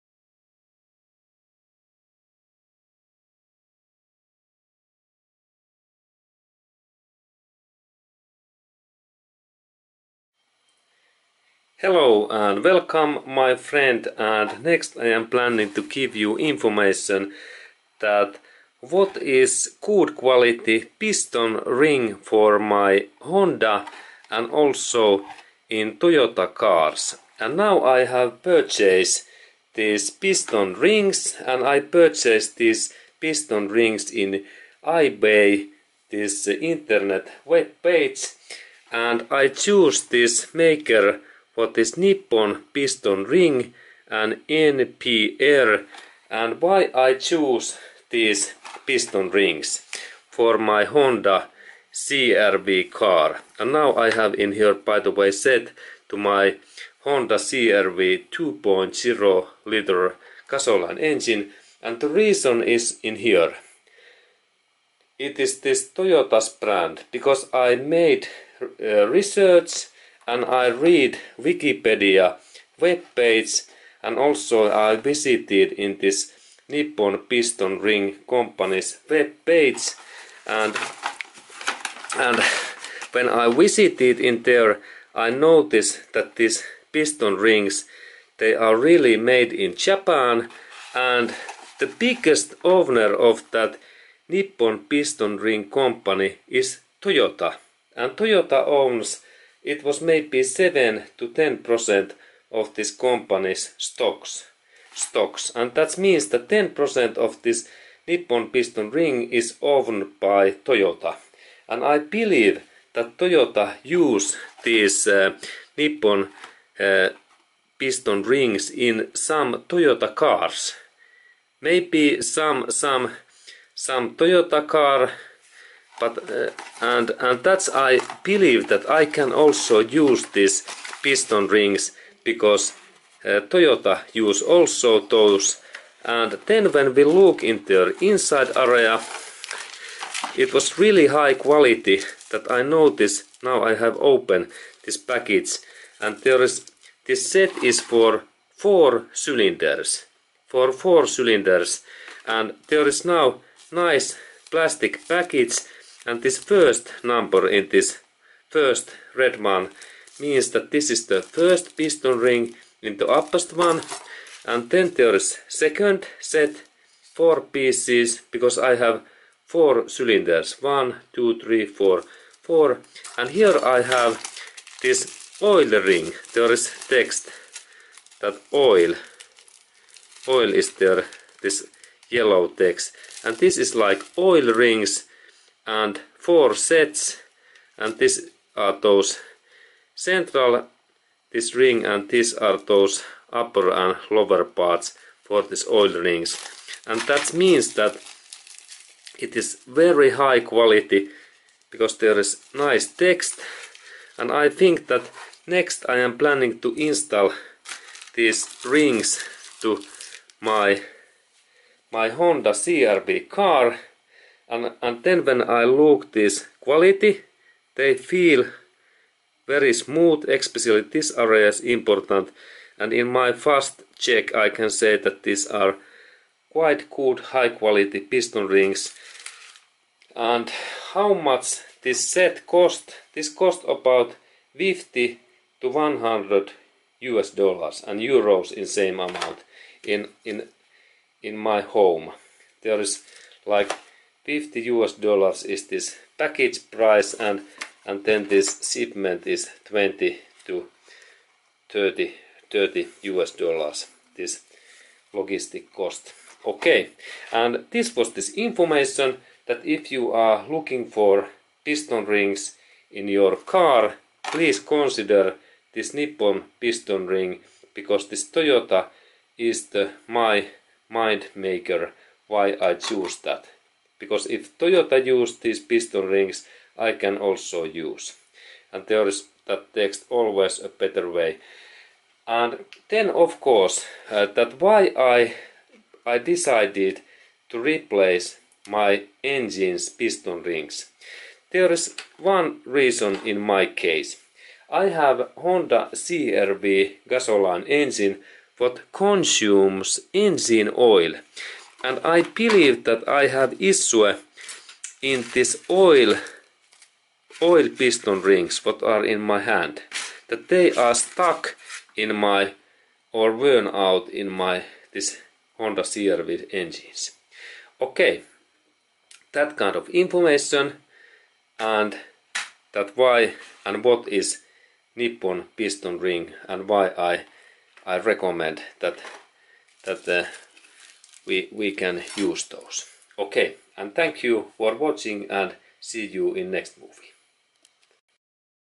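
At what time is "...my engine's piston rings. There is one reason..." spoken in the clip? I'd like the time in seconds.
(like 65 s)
288 s.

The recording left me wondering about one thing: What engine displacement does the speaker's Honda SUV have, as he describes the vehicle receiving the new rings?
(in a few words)
2.0 liter.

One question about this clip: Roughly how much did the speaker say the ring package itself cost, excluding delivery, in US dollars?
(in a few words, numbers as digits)
$50.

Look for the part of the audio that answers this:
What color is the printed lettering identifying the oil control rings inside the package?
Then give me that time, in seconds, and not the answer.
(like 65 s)
182 s.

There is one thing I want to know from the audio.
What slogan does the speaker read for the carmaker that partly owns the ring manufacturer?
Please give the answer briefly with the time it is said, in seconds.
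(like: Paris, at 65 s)
Always a better way, at 280 s.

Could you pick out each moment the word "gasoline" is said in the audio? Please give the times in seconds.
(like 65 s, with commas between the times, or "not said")
60 s, 297 s.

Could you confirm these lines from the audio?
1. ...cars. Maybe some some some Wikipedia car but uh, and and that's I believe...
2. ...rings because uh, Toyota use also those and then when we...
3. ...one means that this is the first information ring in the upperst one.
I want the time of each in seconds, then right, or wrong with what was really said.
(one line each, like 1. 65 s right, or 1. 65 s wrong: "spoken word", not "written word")
1. 120 s wrong: "Toyota", not "Wikipedia"
2. 131 s right
3. 159 s wrong: "piston", not "information".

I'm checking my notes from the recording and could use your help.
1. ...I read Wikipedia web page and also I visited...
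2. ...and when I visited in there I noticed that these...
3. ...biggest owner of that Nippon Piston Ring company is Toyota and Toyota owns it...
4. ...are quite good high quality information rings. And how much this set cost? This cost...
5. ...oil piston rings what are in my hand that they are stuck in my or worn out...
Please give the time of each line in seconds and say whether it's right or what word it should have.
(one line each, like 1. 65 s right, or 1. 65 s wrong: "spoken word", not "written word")
1. 70 s right
2. 82 s right
3. 91 s right
4. 225 s wrong: "piston", not "information"
5. 307 s right.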